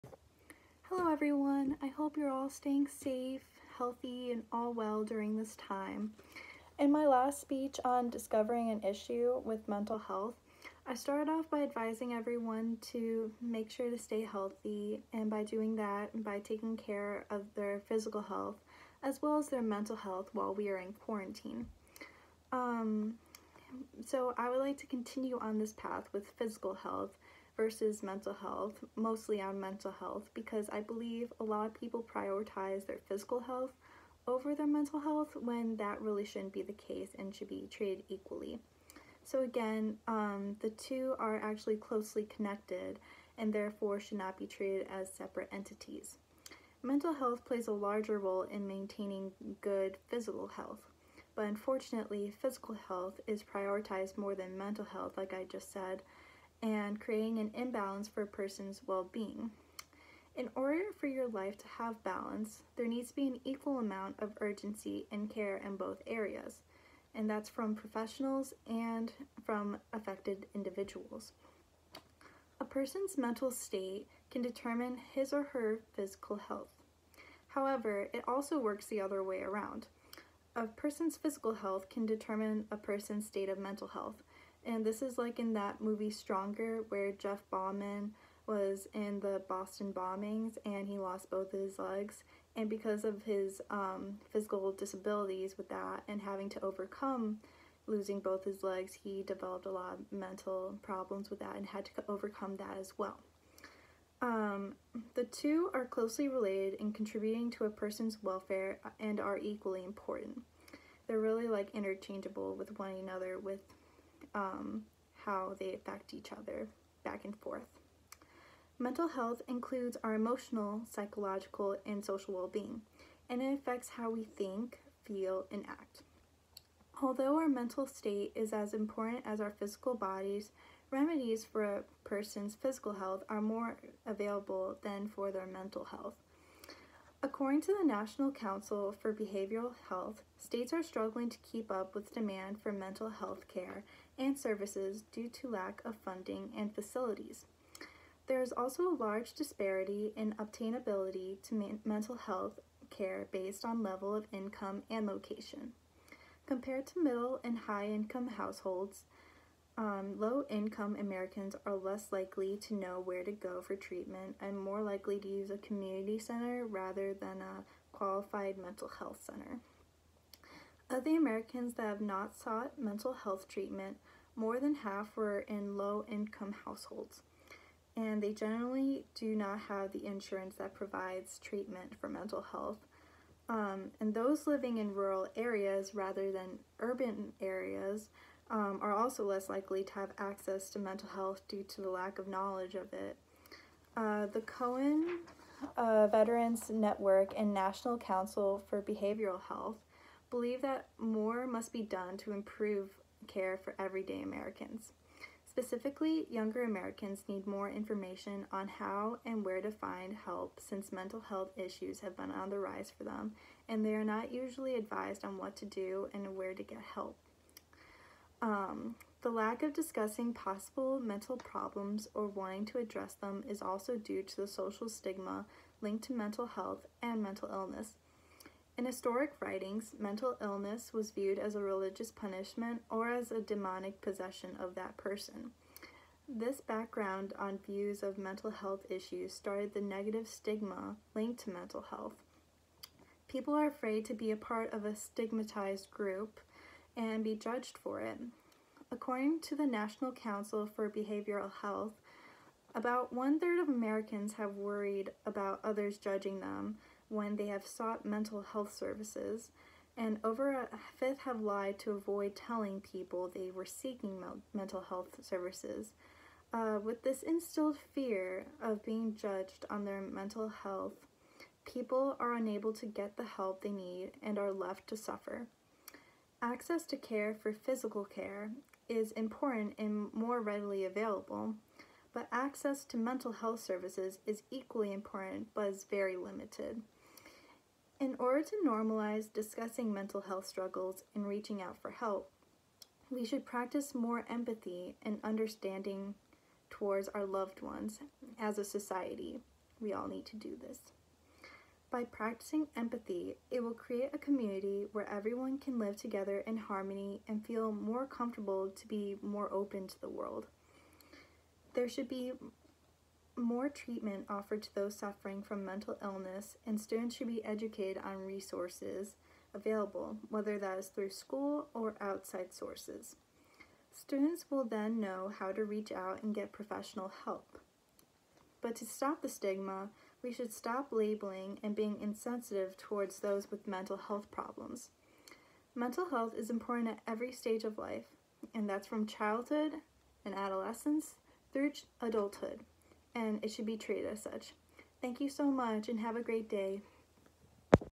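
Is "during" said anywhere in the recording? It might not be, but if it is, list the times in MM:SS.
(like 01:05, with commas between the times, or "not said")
00:05.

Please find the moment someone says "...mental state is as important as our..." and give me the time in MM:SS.
02:07.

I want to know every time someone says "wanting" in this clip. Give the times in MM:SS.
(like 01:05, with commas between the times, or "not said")
03:42.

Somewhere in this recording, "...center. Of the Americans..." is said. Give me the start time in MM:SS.
02:49.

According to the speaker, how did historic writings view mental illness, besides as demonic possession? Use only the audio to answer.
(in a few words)
religious punishment.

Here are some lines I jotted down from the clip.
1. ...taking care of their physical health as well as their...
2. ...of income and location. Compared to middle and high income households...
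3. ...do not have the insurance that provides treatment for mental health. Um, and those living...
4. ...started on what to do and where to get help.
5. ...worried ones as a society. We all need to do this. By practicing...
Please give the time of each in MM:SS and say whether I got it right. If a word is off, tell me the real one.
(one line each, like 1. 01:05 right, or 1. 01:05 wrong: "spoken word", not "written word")
1. 00:16 right
2. 02:34 right
3. 02:59 right
4. 03:34 wrong: "advised", not "started"
5. 04:57 wrong: "loved", not "worried".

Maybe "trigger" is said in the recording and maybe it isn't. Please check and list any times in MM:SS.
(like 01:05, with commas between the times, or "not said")
not said.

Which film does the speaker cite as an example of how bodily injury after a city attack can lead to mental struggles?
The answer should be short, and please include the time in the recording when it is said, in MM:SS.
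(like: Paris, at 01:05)
Stronger, at 01:26.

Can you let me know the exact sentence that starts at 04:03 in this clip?
People are afraid to be a part of a stigmatized group and be judged for it.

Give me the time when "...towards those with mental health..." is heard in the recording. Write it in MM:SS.
05:32.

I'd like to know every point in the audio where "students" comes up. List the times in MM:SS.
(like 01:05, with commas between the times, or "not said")
05:16, 05:23.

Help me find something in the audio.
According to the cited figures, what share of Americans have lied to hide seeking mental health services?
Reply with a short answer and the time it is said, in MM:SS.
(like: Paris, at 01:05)
a fifth, at 04:20.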